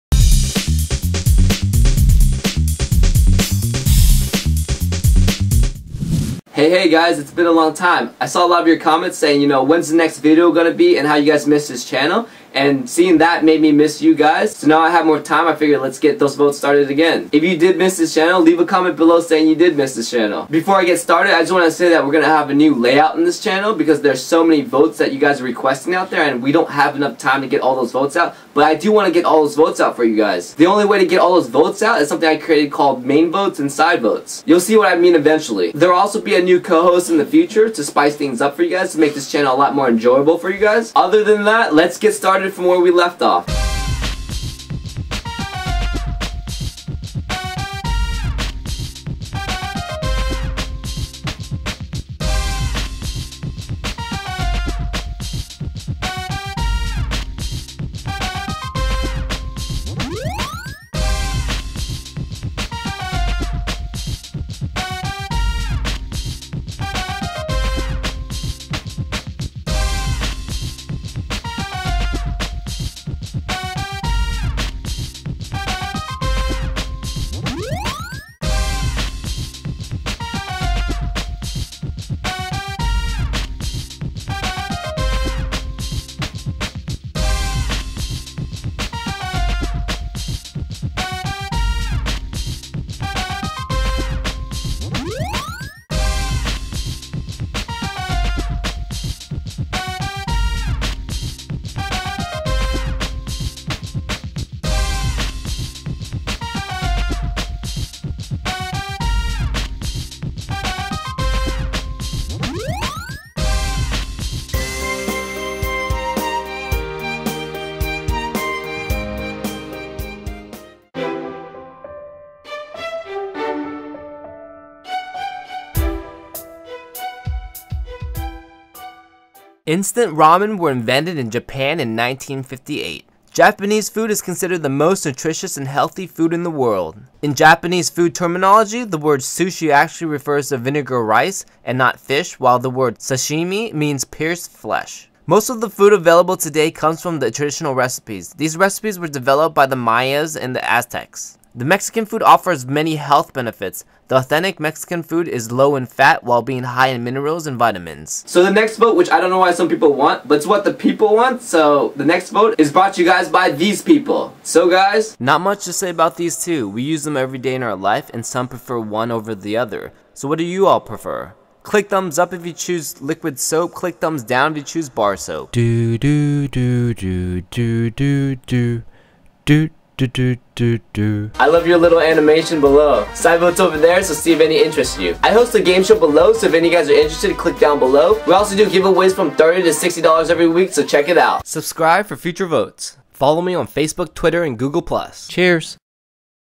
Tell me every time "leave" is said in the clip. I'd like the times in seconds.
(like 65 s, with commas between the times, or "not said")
18 s.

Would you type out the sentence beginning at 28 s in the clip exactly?
But I do want to get all those votes out for you guys.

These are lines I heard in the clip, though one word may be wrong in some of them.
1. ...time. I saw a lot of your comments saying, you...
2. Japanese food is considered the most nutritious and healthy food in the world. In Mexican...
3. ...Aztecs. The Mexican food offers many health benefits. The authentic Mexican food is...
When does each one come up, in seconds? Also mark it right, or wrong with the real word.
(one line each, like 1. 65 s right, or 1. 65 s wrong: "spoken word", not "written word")
1. 7 s right
2. 133 s wrong: "Japanese", not "Mexican"
3. 150 s right.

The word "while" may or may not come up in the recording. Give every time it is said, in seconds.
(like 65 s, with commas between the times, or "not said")
142 s, 156 s.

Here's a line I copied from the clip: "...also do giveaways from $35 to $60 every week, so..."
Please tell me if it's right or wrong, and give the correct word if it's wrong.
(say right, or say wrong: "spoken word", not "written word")
wrong: "30", not "35".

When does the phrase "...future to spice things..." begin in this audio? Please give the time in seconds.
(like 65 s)
37 s.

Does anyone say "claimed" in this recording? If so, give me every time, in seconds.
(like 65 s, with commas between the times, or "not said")
not said.